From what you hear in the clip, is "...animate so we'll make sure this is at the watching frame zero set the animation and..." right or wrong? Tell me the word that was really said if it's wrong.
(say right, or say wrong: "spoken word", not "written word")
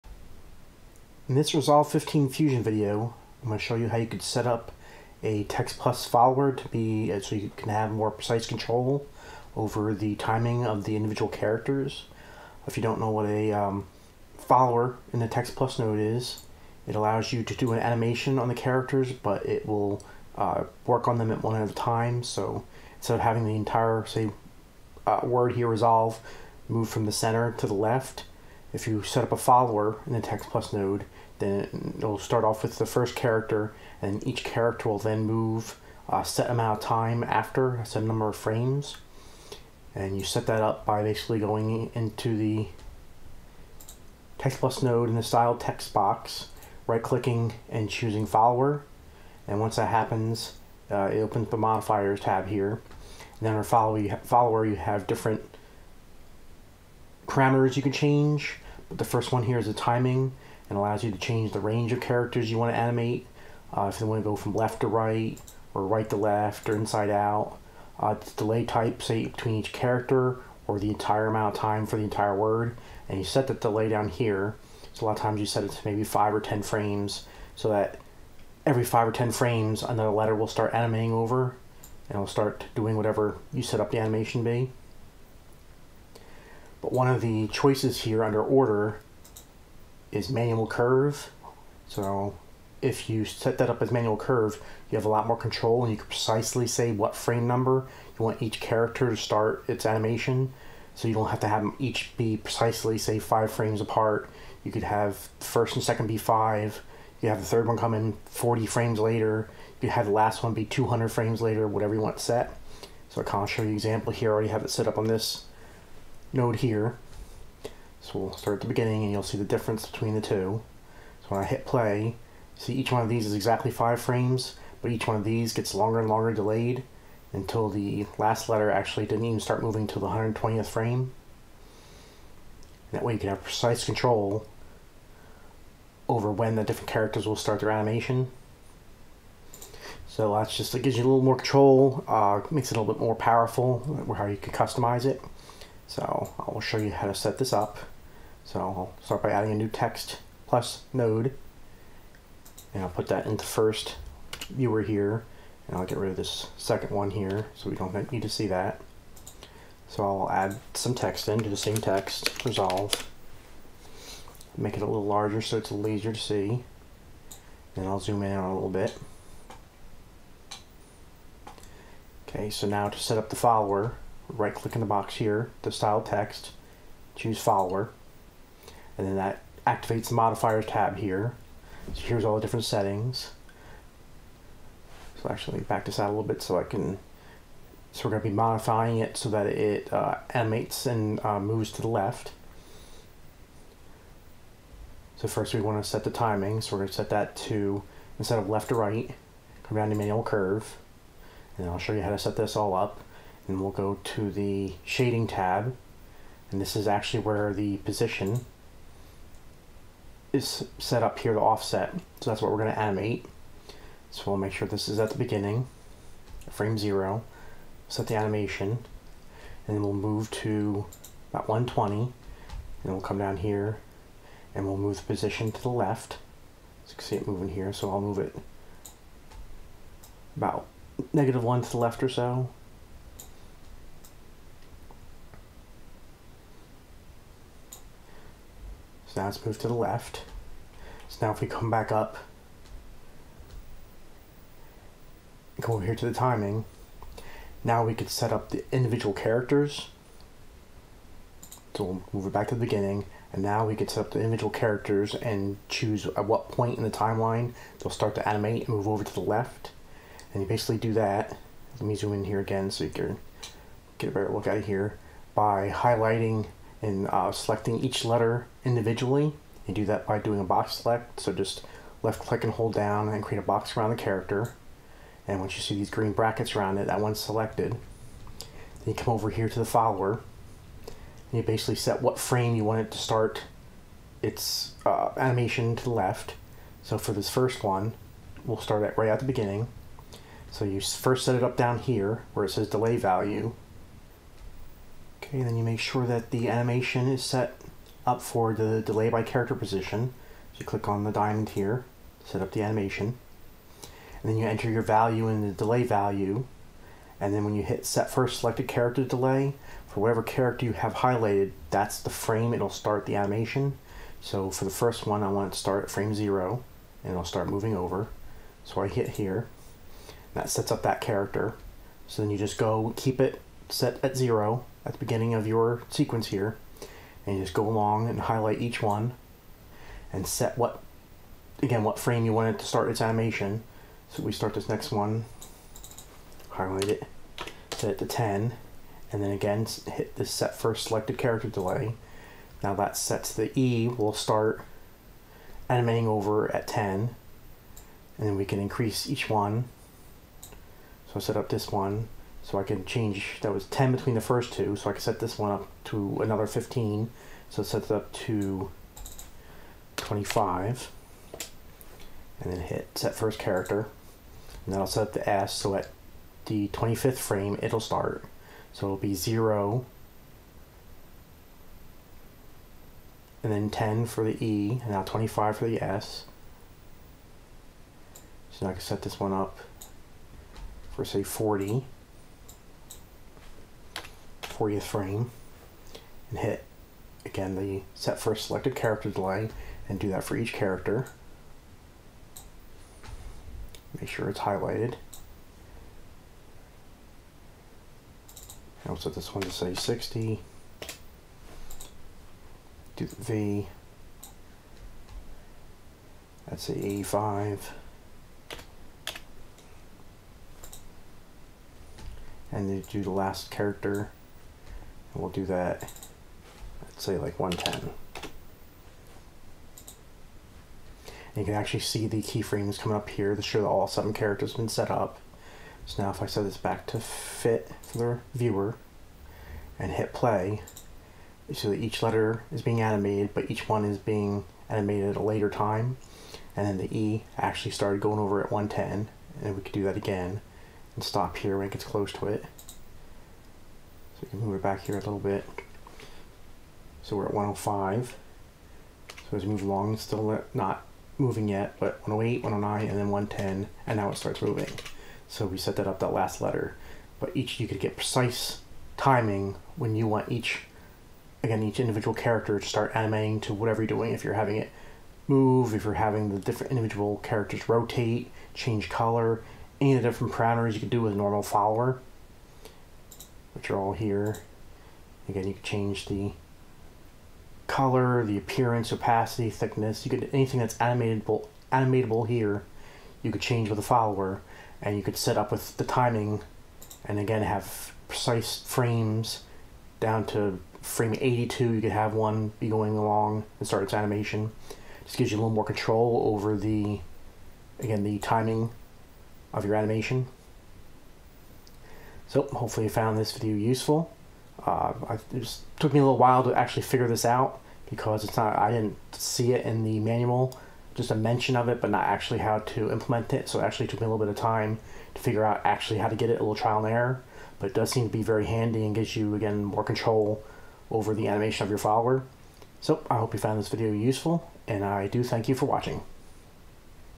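wrong: "beginning", not "watching".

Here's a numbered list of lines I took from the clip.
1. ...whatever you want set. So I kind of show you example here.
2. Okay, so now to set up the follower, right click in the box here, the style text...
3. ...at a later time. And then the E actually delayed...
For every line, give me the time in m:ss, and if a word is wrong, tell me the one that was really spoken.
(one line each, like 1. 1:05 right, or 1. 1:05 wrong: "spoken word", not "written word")
1. 1:51 right
2. 2:52 right
3. 7:15 wrong: "started", not "delayed".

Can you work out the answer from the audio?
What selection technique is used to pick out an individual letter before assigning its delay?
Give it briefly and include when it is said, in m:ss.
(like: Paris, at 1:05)
Box select, at 4:30.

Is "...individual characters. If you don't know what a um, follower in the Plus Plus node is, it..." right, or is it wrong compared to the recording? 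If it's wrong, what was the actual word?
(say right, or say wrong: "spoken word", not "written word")
wrong: "Text", not "Plus".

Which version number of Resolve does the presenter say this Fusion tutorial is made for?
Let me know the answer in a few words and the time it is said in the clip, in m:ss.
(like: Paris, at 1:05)
15, at 0:01.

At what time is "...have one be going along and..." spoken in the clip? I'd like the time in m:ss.
8:11.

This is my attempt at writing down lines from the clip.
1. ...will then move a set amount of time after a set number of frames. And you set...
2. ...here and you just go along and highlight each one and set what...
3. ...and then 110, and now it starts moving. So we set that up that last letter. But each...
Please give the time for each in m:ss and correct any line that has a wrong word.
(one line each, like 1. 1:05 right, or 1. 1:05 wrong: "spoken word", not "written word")
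1. 0:34 right
2. 5:26 right
3. 7:32 right.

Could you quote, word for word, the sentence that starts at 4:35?
And once you see these green brackets around it, that one's selected.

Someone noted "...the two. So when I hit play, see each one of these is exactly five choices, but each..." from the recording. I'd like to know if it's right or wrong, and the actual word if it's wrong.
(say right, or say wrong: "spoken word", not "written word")
wrong: "frames", not "choices".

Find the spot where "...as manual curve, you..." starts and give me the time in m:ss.
1:33.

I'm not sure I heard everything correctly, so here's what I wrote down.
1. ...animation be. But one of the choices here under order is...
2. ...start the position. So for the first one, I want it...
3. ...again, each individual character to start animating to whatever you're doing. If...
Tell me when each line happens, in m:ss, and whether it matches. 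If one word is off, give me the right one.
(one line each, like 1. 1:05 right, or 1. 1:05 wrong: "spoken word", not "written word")
1. 1:23 right
2. 5:12 wrong: "animation", not "position"
3. 7:41 right.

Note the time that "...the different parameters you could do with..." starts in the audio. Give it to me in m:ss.
7:50.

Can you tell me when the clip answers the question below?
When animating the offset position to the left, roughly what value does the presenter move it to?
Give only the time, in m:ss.
3:51.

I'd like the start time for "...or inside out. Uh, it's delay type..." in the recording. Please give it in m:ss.
1:06.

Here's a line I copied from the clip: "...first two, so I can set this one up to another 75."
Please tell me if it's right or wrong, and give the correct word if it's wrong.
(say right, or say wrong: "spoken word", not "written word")
wrong: "15", not "75".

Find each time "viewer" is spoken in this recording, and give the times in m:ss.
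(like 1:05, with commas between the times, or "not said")
2:34, 7:08.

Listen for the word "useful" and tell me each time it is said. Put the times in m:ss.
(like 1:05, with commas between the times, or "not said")
8:23, 8:43.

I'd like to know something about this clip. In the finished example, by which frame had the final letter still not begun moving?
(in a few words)
120.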